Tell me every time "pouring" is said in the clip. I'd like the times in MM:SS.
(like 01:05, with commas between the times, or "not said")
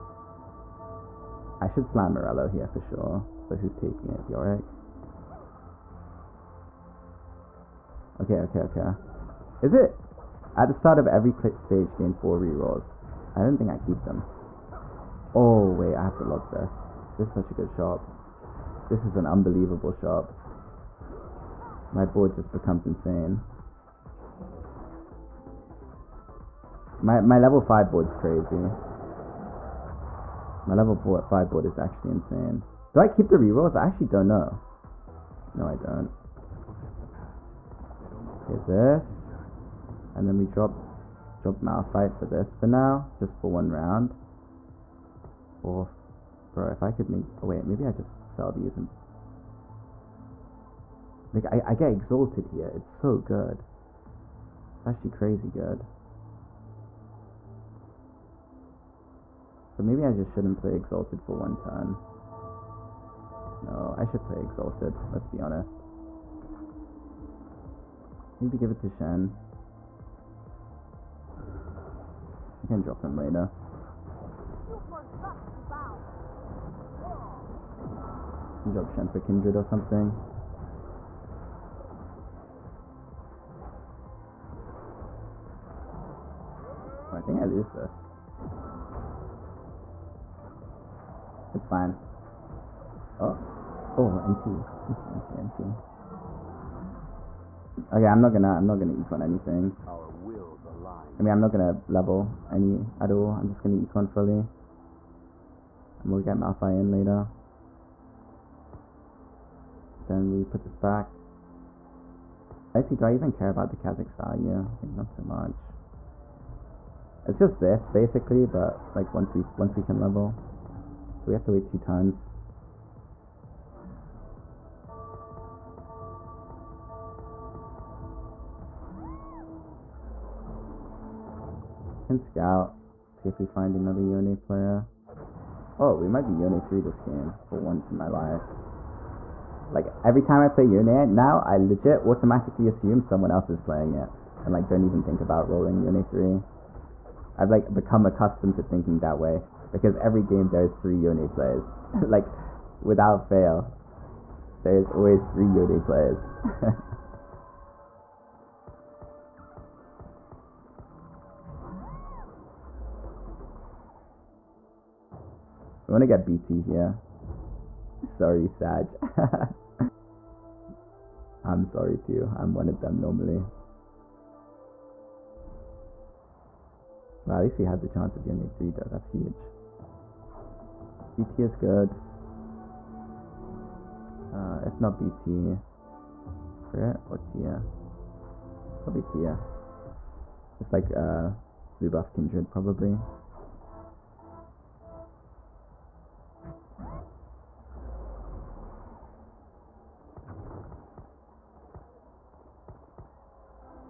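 not said.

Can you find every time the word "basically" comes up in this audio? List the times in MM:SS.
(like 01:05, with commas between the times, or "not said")
01:57.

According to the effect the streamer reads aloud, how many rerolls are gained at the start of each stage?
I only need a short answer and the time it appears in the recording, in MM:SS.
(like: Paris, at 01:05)
4, at 00:11.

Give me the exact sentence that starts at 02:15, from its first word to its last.
Oh, we might be Yone 3 this game for once in my life.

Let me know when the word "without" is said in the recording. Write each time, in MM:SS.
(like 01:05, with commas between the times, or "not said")
02:32.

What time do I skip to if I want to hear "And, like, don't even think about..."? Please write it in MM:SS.
02:24.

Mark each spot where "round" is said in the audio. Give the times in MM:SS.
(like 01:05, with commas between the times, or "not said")
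00:43.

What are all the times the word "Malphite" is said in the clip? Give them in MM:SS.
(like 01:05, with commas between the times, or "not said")
00:41, 01:46.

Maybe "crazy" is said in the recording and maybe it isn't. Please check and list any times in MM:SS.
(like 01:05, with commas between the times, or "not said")
00:28, 00:55.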